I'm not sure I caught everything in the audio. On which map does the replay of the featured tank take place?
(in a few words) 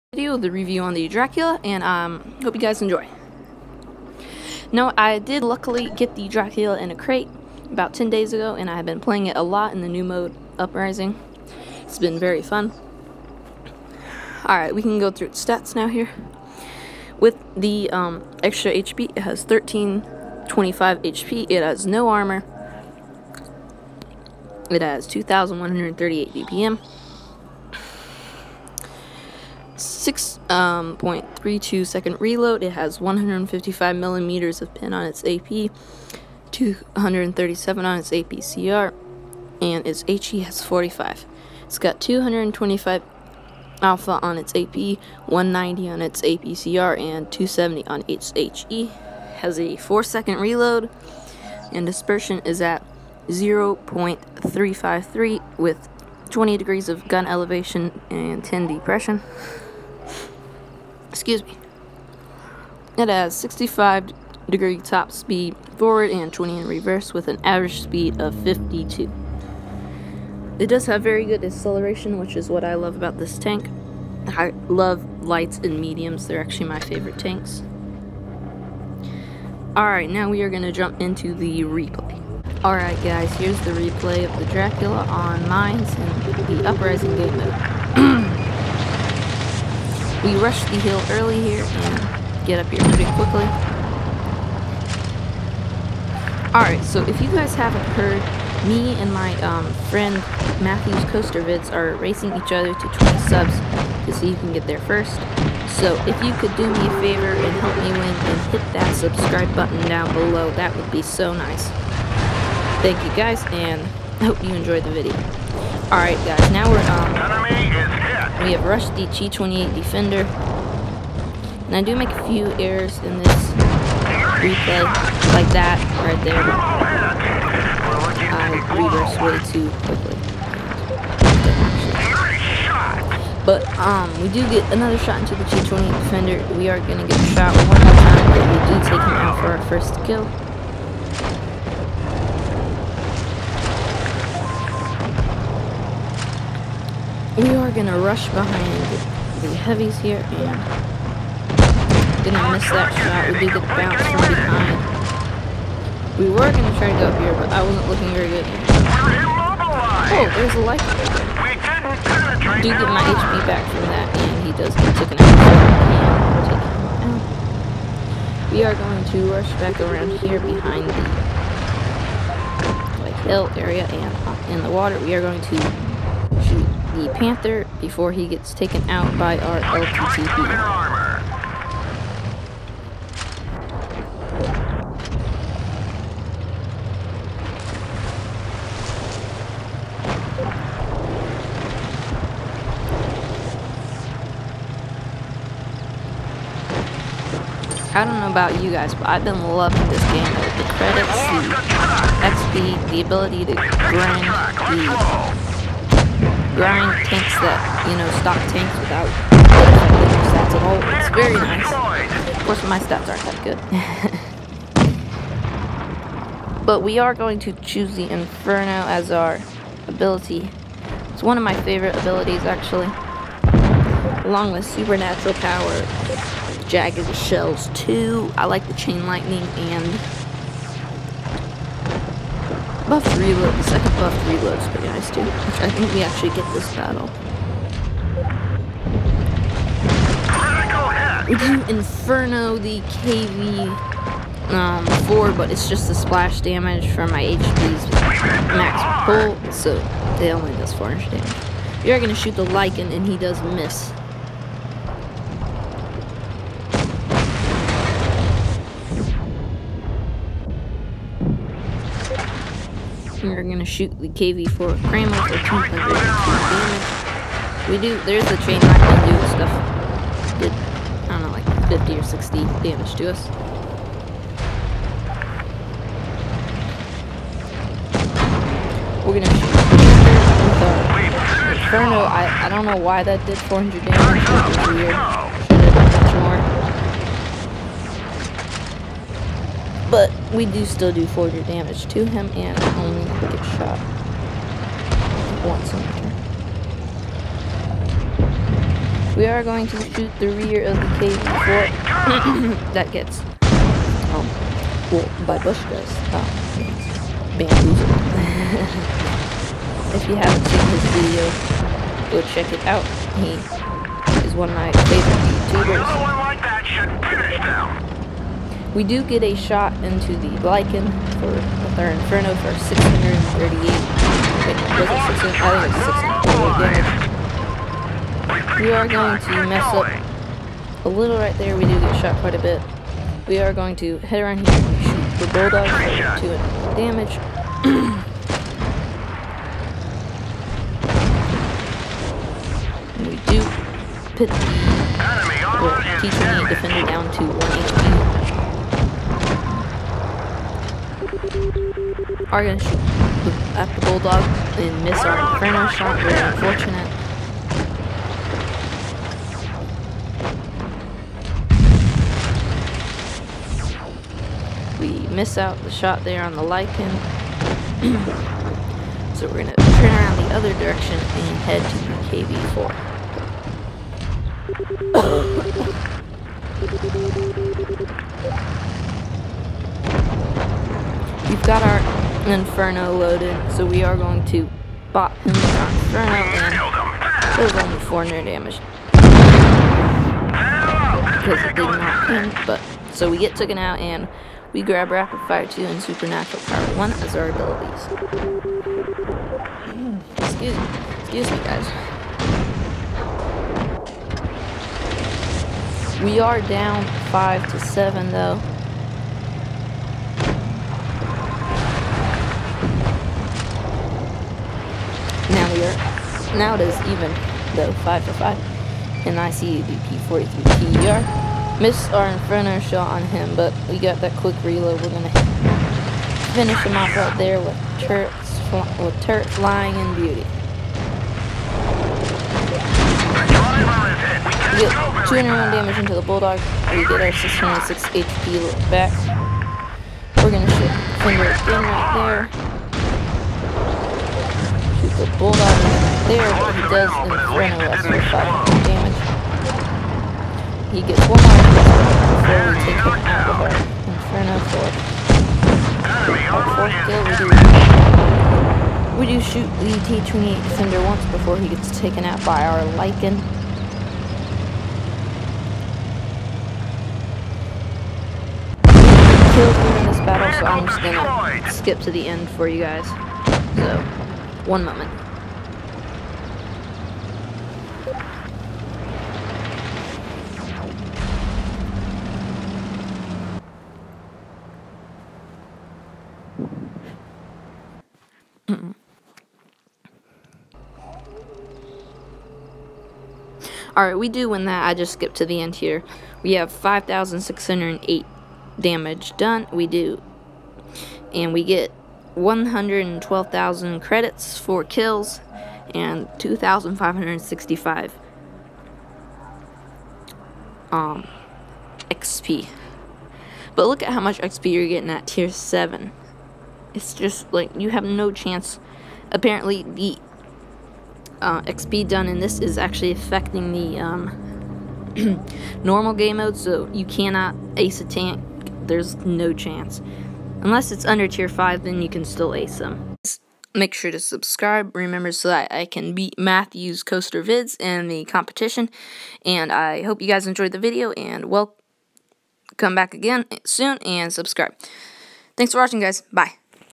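Mines.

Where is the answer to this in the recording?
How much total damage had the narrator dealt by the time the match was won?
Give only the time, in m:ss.
8:16.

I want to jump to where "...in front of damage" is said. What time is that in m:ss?
7:26.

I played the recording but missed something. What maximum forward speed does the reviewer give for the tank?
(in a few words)
65.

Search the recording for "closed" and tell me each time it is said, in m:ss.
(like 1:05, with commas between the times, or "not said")
not said.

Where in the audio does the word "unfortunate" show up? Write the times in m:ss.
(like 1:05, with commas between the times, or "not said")
5:56.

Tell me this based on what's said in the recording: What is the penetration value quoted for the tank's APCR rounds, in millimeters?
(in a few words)
237.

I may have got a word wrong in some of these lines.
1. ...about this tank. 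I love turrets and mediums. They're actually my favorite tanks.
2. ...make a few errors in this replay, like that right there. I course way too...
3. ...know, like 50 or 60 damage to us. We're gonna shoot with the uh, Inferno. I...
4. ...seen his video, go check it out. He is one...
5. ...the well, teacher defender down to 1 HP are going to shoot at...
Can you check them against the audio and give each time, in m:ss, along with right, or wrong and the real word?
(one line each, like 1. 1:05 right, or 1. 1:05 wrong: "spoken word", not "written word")
1. 1:12 wrong: "lights", not "turrets"
2. 2:01 wrong: "reverse", not "course"
3. 4:31 right
4. 5:10 right
5. 5:44 right.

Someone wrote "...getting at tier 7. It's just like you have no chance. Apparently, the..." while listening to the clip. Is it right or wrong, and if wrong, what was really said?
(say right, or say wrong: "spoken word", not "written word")
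right.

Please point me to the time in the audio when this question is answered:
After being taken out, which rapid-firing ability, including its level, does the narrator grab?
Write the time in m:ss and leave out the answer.
6:34.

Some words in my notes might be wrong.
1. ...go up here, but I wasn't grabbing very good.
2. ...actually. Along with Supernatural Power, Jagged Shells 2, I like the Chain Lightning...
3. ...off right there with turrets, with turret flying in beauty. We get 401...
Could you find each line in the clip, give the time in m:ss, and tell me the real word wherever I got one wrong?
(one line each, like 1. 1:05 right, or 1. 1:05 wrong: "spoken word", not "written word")
1. 2:37 wrong: "looking", not "grabbing"
2. 3:42 right
3. 7:06 wrong: "201", not "401".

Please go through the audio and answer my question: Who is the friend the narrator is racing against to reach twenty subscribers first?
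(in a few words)
Matthews Kostervitz.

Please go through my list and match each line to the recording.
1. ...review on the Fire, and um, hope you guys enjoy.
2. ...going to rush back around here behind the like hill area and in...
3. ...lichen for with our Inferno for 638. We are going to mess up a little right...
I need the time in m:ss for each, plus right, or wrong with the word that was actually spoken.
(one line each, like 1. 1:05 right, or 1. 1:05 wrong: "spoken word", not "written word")
1. 0:00 wrong: "Dracula", not "Fire"
2. 2:48 right
3. 5:20 right.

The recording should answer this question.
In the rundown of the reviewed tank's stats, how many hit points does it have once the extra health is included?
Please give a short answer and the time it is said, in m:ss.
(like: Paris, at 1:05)
1325, at 0:19.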